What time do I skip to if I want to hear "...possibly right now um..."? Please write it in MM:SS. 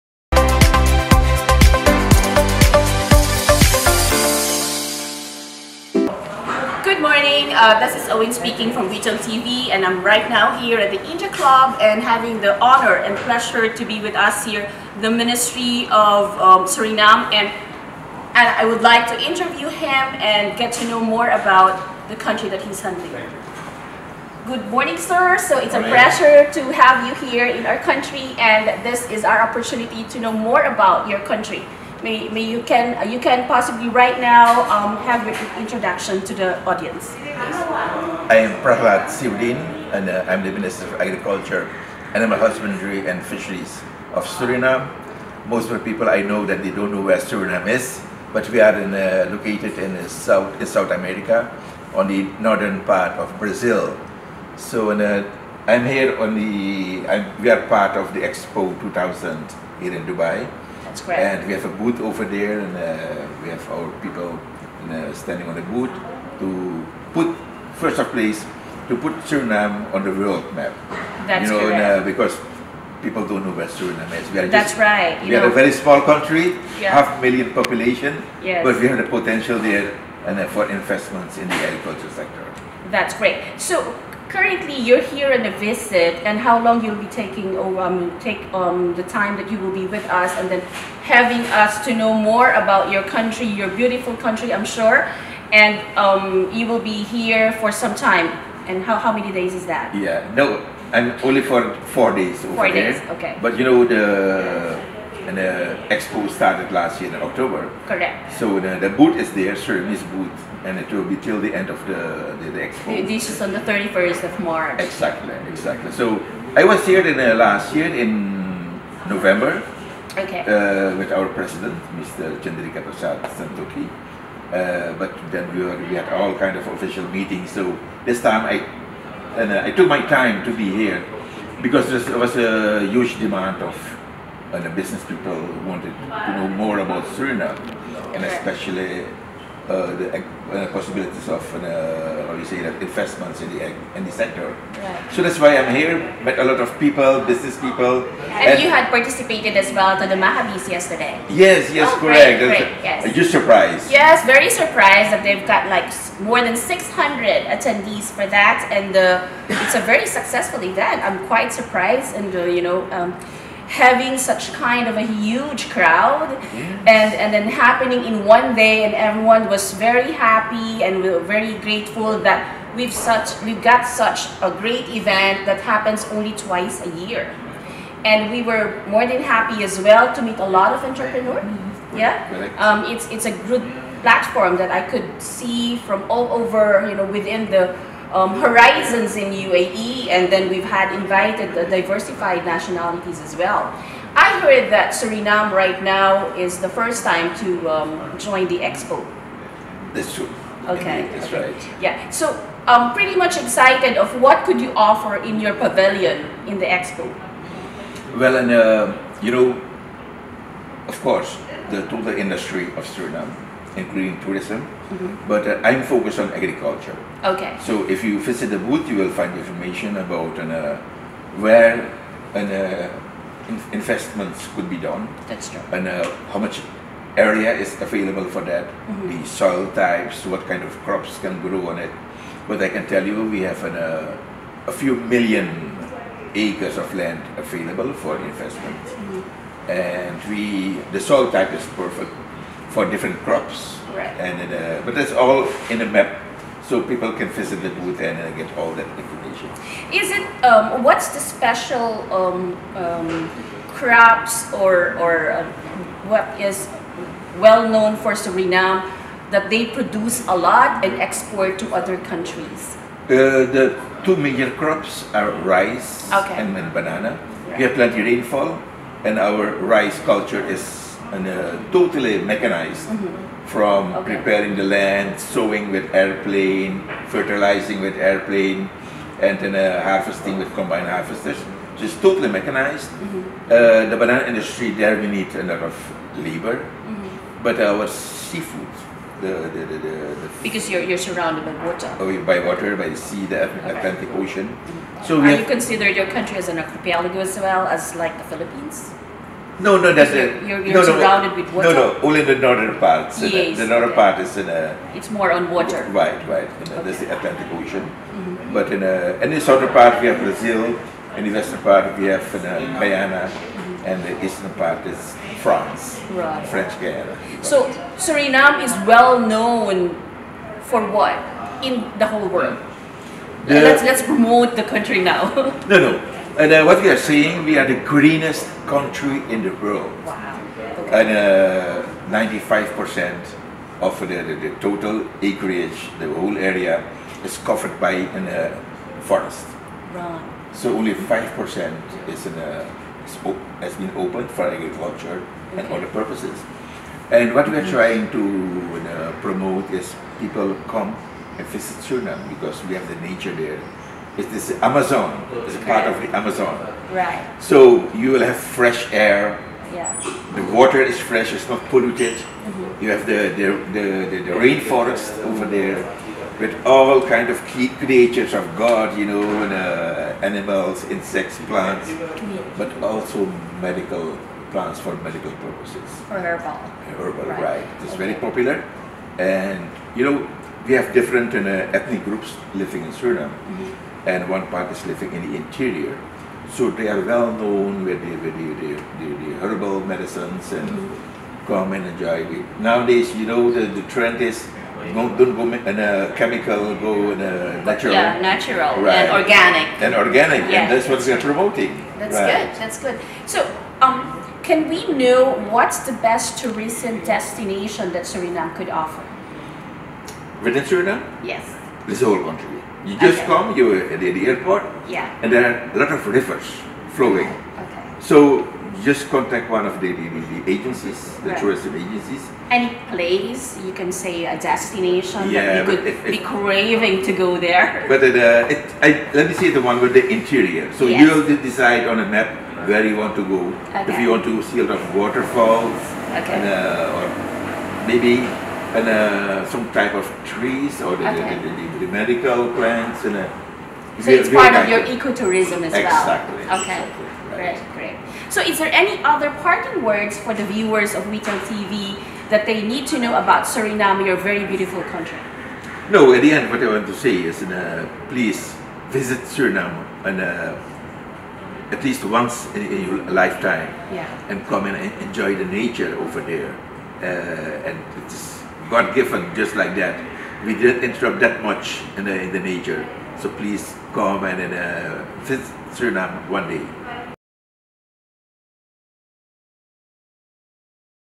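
00:33.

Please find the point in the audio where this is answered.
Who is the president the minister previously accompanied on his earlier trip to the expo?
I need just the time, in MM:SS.
02:02.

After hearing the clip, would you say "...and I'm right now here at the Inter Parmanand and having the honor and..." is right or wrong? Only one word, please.
wrong.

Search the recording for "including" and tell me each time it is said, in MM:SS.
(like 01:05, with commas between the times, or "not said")
03:33.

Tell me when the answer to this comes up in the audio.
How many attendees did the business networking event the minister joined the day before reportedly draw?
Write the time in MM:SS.
02:36.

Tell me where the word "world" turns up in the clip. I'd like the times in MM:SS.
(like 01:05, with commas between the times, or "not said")
01:10, 05:22, 05:29.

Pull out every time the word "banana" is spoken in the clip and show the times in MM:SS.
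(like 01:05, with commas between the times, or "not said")
04:26, 04:43.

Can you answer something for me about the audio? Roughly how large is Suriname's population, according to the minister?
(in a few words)
half million.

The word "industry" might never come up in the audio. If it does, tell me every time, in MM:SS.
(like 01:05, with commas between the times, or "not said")
03:32, 04:44.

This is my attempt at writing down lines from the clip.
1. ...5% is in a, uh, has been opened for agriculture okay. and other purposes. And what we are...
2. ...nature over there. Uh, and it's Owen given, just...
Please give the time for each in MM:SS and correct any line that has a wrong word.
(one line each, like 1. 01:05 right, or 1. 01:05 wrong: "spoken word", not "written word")
1. 05:40 right
2. 07:45 wrong: "God", not "Owen".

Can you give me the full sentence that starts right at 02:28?
And, and you had participated as well to the Mahabis yesterday.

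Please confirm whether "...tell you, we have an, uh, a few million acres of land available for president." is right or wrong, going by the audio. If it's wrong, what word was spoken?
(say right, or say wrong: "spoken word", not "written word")
wrong: "investment", not "president".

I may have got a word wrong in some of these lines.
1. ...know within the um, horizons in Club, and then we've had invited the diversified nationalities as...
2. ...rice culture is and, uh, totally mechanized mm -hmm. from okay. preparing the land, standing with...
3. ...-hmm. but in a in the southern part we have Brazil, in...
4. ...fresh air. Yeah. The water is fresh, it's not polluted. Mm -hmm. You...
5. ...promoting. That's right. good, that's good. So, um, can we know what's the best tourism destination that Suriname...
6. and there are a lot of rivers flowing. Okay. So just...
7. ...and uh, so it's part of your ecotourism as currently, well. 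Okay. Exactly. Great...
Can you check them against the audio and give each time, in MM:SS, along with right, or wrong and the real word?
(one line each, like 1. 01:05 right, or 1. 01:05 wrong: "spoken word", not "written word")
1. 03:06 wrong: "UAE", not "Club"
2. 04:29 wrong: "sowing", not "standing"
3. 05:08 right
4. 05:58 right
5. 06:41 right
6. 06:55 right
7. 07:23 wrong: "exactly", not "currently".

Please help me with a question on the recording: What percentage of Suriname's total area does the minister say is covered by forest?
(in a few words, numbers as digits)
95%.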